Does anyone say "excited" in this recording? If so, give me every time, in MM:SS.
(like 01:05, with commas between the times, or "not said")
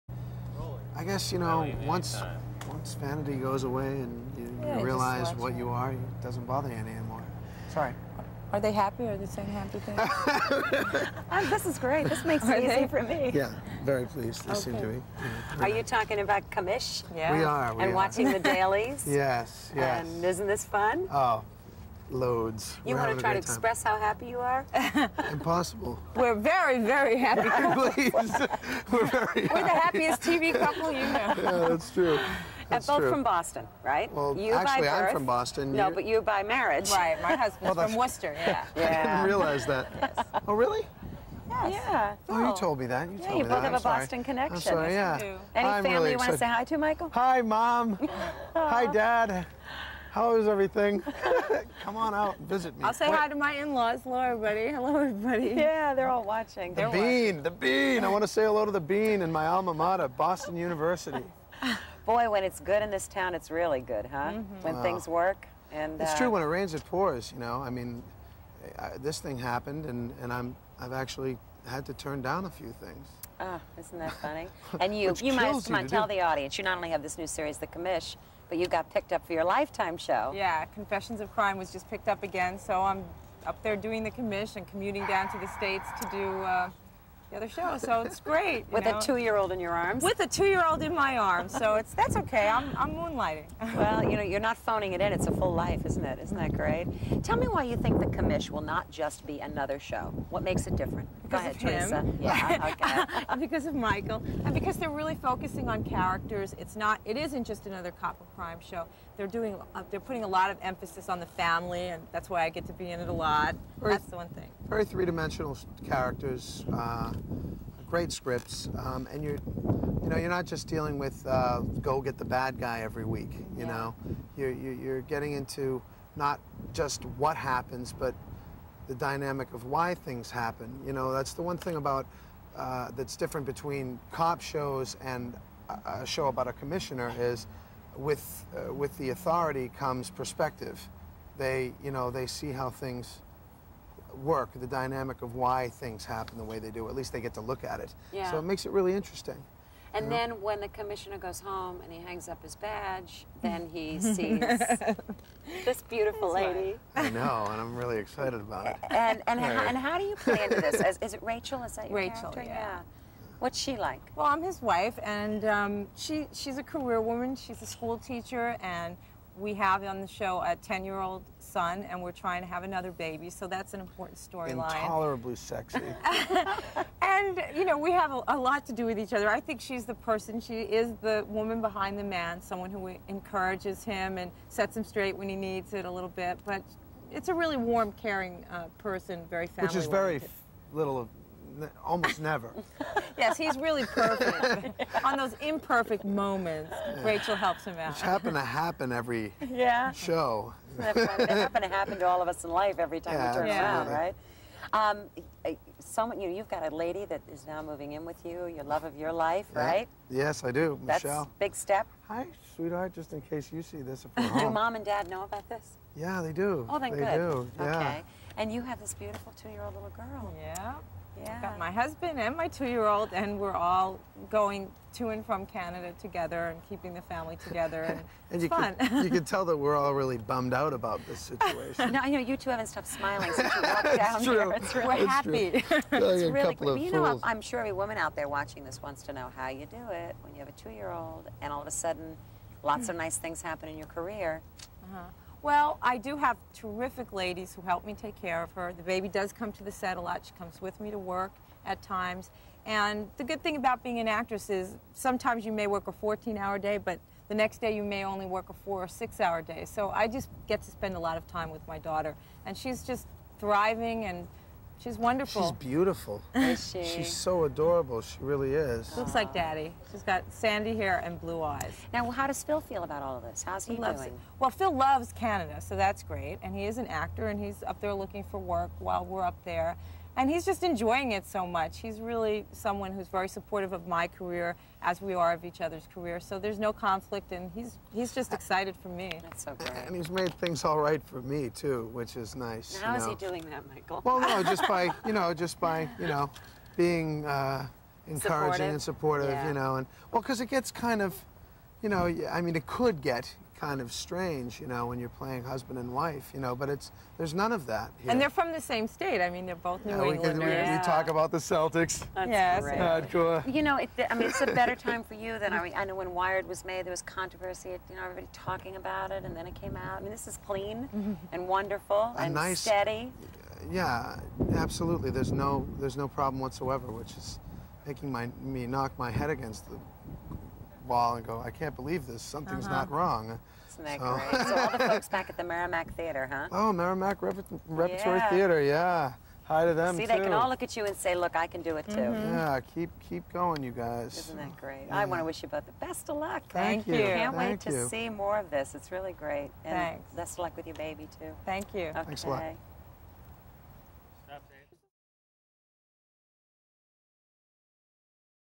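02:37, 04:48.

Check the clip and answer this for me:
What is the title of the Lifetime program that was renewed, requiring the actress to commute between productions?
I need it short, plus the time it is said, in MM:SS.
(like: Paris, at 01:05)
Confessions of Crime, at 01:20.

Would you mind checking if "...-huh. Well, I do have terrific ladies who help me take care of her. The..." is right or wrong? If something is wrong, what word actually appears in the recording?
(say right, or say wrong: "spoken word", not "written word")
right.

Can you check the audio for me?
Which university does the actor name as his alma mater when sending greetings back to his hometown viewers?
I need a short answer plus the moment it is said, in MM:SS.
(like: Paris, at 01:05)
Boston University, at 01:00.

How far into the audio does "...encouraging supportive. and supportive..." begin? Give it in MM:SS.
04:58.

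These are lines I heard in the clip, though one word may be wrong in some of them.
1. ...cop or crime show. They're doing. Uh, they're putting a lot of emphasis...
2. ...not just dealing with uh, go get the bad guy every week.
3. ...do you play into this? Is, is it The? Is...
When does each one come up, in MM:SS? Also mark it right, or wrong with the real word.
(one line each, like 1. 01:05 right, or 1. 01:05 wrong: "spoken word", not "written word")
1. 01:47 right
2. 02:00 right
3. 02:39 wrong: "Rachel", not "The".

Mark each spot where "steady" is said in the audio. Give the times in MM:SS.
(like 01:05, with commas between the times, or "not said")
05:22.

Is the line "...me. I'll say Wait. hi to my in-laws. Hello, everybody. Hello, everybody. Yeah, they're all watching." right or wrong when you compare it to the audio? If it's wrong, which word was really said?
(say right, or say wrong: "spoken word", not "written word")
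right.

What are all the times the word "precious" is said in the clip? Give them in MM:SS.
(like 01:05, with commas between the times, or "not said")
not said.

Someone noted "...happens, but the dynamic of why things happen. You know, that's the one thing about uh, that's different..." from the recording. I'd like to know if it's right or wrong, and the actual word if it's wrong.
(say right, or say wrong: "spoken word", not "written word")
right.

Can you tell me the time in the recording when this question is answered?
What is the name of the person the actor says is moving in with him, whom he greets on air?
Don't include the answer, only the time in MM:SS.
03:31.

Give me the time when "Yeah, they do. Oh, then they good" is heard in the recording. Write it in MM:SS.
03:35.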